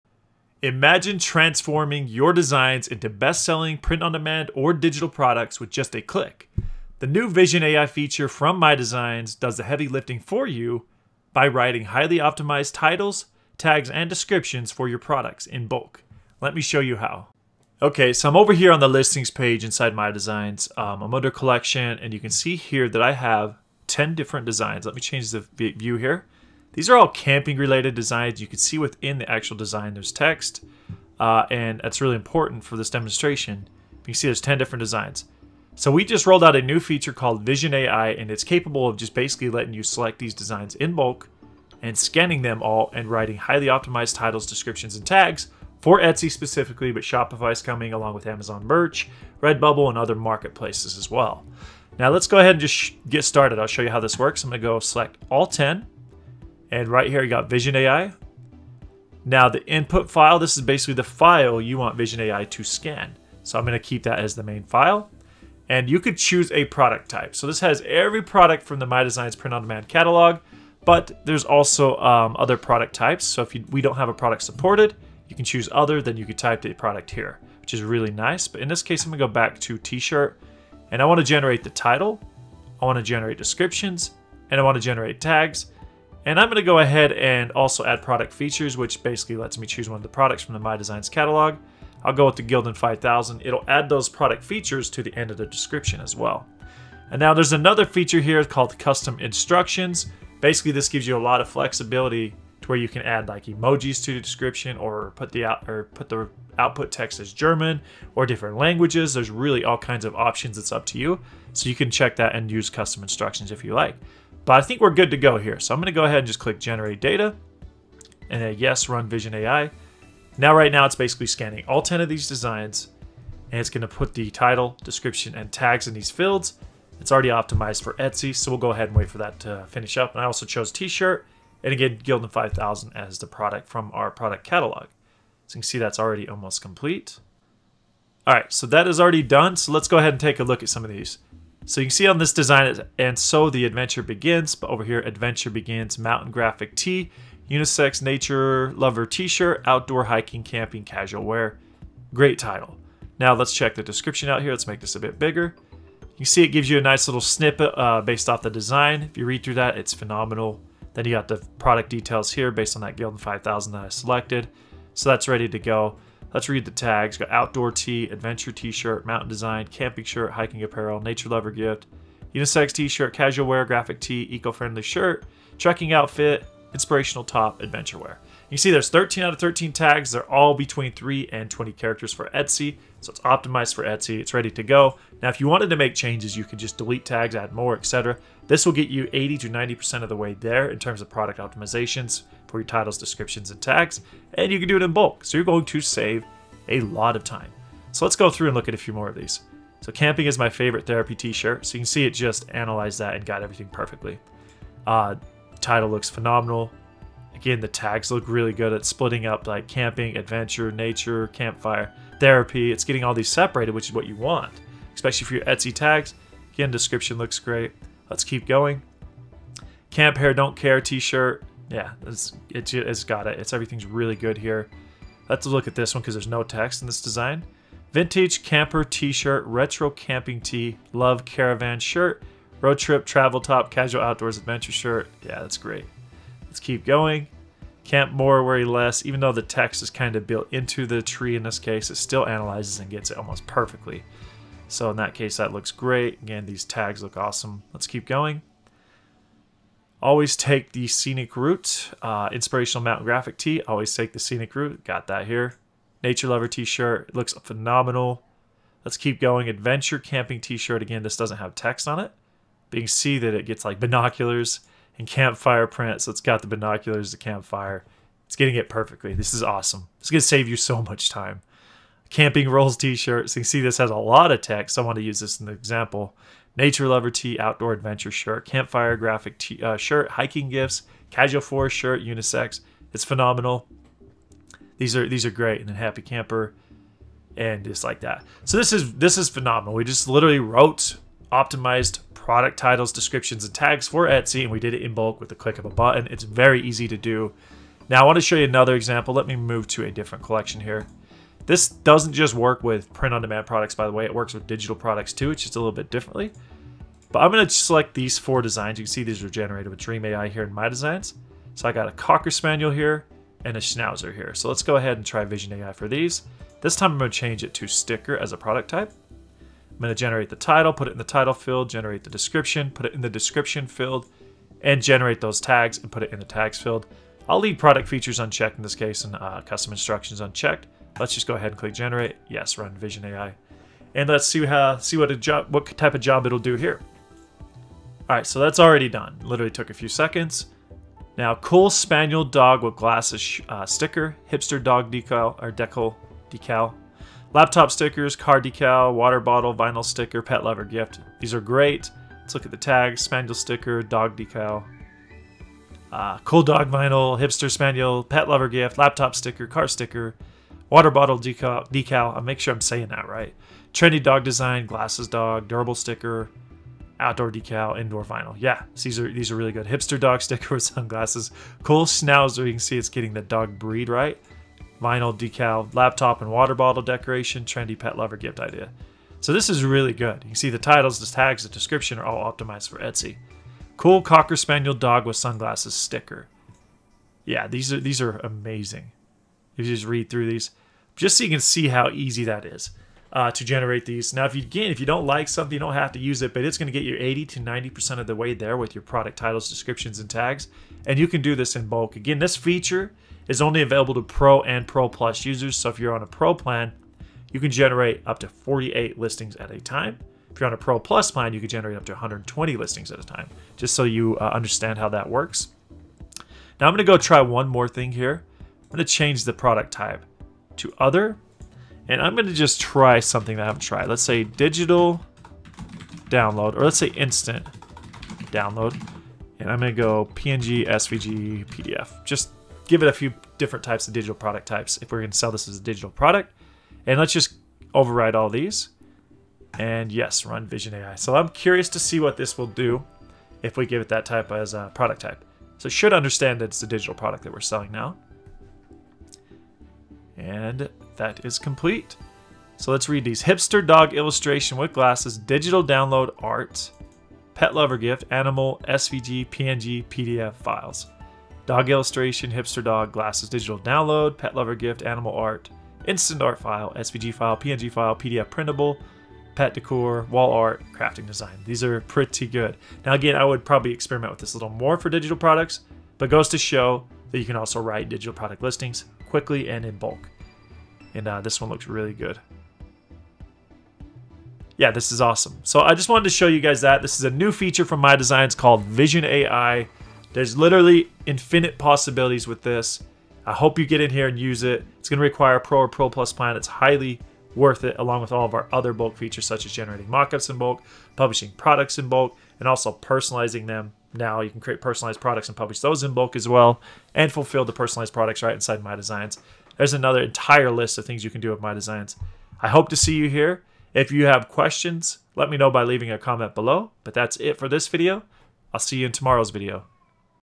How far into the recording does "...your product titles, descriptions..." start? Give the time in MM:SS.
06:38.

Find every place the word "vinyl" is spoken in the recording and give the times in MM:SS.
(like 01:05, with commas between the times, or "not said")
05:49, 05:56, 06:08, 06:14.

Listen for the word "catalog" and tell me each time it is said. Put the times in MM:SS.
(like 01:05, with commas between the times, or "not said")
01:09, 01:31, 02:14.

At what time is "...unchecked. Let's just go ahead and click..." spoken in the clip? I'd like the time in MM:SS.
05:30.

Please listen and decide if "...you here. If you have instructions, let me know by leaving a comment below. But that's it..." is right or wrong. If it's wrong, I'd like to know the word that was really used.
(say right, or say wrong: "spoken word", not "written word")
wrong: "questions", not "instructions".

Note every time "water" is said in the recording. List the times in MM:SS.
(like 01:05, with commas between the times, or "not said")
05:48, 06:00, 06:16.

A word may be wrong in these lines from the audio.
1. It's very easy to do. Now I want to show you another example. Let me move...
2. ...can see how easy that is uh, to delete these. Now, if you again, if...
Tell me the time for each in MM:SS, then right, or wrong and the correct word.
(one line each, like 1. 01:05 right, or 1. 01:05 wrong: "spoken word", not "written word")
1. 04:56 right
2. 06:31 wrong: "generate", not "delete".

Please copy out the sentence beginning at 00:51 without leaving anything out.
Now let's go ahead and just get started.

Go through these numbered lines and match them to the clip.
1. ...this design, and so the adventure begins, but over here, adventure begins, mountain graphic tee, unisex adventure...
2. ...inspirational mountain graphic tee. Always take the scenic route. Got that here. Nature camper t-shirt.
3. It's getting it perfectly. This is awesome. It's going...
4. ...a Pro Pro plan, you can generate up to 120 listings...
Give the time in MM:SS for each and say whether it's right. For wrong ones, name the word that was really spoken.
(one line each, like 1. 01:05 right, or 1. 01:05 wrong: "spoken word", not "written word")
1. 02:22 wrong: "nature", not "adventure"
2. 04:12 wrong: "lover", not "camper"
3. 04:28 right
4. 06:50 wrong: "Plus", not "Pro".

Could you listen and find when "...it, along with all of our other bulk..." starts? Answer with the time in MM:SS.
08:17.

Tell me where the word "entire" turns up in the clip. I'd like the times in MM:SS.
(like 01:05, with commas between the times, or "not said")
08:30.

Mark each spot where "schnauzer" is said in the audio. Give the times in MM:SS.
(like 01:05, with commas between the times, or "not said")
05:13, 06:11.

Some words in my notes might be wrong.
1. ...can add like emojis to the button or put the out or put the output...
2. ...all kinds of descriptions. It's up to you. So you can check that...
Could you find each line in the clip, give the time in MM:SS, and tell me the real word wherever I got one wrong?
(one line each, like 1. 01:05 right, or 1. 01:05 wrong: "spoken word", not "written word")
1. 01:42 wrong: "description", not "button"
2. 01:49 wrong: "options", not "descriptions".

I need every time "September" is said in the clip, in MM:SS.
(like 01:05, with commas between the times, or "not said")
not said.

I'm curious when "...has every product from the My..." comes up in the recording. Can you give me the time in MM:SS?
01:07.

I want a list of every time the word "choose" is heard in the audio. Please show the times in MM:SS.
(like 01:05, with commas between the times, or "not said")
01:06, 01:15, 01:29.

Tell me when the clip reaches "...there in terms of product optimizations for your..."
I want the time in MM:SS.
03:10.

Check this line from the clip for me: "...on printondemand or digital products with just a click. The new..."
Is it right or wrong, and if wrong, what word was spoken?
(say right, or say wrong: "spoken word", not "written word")
wrong: "demand", not "printondemand".